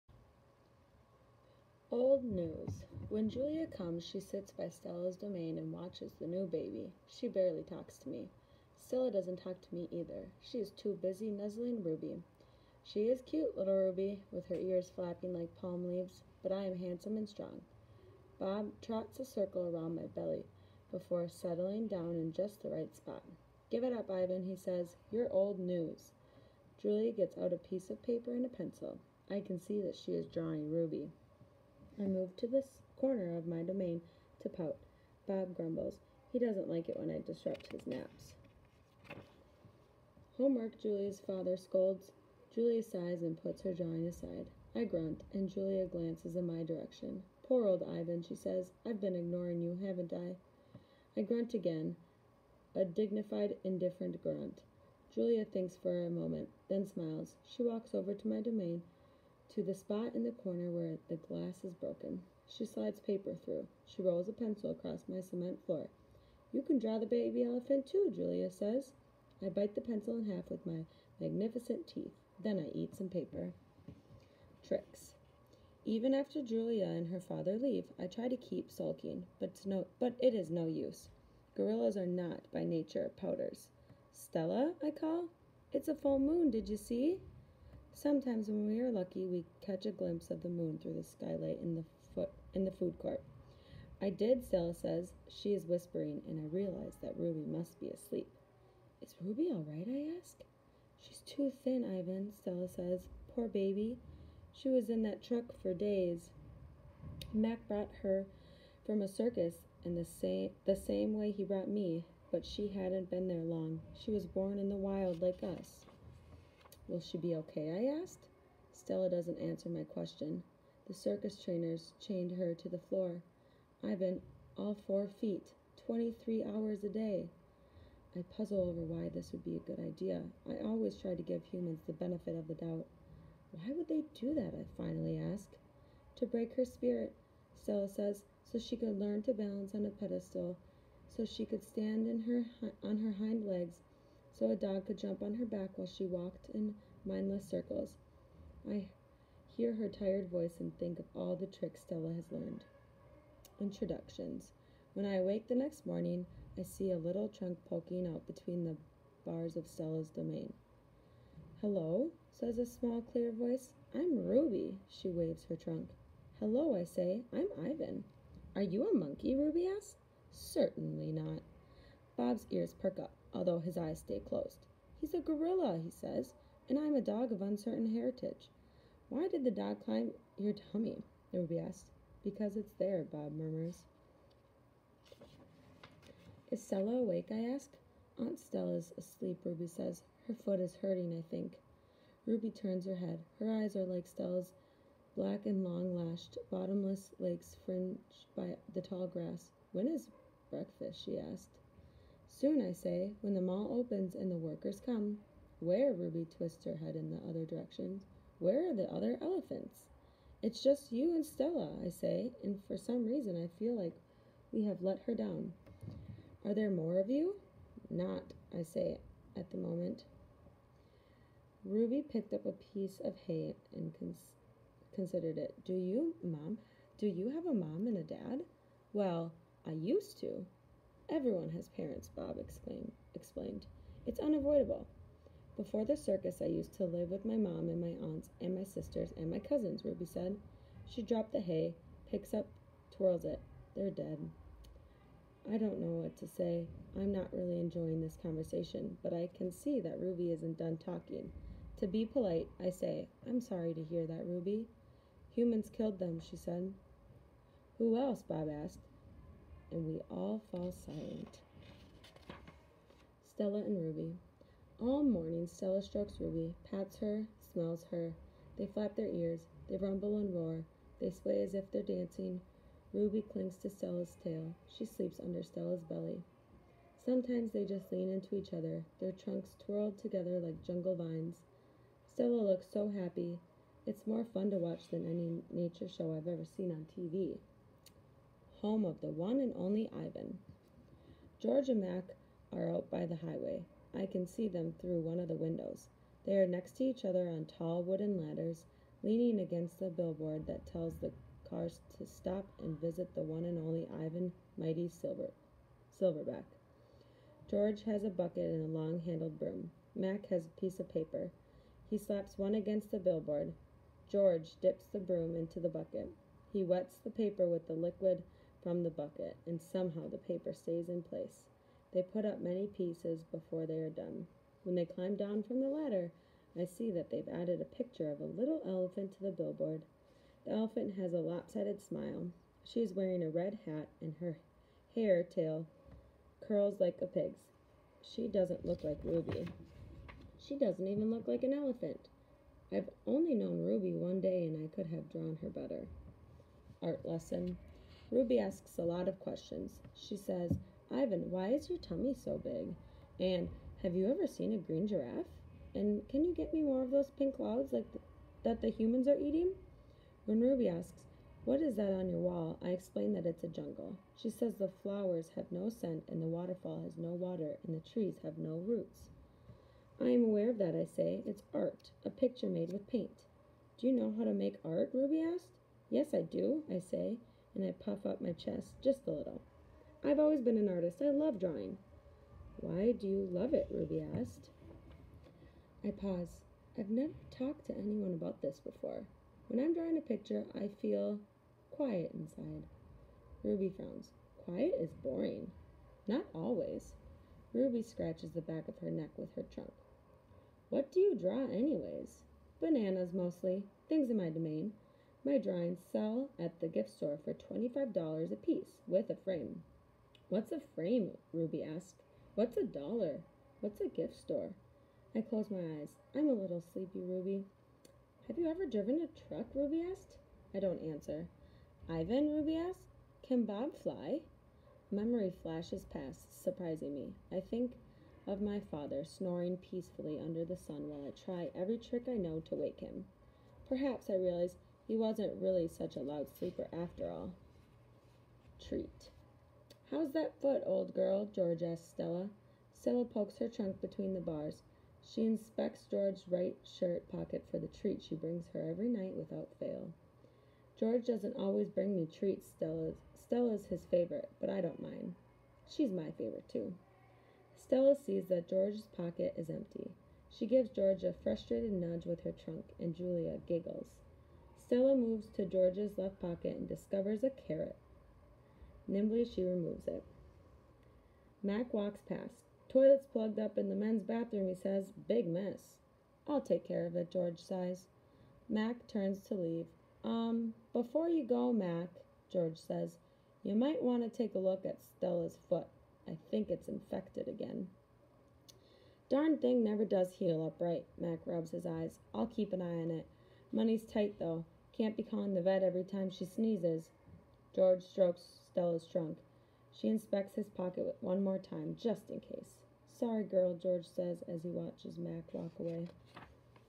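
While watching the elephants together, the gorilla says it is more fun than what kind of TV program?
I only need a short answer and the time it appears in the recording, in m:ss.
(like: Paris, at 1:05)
Nature show, at 4:45.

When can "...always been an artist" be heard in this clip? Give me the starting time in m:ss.
6:20.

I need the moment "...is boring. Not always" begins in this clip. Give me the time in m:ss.
6:34.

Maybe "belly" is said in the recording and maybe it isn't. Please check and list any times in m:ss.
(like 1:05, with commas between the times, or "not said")
0:20, 4:35.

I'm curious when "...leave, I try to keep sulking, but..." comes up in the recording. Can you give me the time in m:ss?
1:17.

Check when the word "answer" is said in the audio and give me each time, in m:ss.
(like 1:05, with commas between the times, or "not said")
1:59, 7:00.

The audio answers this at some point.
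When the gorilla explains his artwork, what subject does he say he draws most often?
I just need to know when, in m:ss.
6:42.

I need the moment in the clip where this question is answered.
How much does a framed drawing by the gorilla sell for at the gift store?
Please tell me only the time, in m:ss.
6:47.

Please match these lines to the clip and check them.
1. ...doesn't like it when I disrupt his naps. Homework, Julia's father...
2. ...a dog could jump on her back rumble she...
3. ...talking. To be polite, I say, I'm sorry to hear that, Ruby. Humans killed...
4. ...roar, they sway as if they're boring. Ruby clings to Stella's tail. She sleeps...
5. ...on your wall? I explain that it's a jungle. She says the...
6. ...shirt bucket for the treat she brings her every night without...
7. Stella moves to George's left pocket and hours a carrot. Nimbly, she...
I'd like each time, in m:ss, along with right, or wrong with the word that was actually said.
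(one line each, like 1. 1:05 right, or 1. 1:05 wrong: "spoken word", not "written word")
1. 0:36 right
2. 2:24 wrong: "while", not "rumble"
3. 4:10 right
4. 4:30 wrong: "dancing", not "boring"
5. 6:01 right
6. 7:26 wrong: "pocket", not "bucket"
7. 7:44 wrong: "discovers", not "hours".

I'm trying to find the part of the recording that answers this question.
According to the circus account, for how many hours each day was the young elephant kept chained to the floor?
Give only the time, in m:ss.
2:05.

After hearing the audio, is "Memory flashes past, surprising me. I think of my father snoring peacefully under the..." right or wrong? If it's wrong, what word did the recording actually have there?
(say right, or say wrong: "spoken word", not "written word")
right.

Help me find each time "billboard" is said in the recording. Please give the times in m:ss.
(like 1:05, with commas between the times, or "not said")
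4:59, 5:12, 5:29.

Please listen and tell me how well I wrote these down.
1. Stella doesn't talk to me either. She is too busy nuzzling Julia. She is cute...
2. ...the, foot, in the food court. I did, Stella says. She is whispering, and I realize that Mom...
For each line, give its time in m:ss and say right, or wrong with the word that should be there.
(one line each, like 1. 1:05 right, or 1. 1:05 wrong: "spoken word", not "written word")
1. 0:08 wrong: "Ruby", not "Julia"
2. 1:31 wrong: "Ruby", not "Mom".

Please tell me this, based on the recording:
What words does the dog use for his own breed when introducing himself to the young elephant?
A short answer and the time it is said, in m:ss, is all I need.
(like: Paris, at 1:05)
Uncertain heritage, at 2:57.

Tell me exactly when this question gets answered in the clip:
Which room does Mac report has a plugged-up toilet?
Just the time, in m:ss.
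7:53.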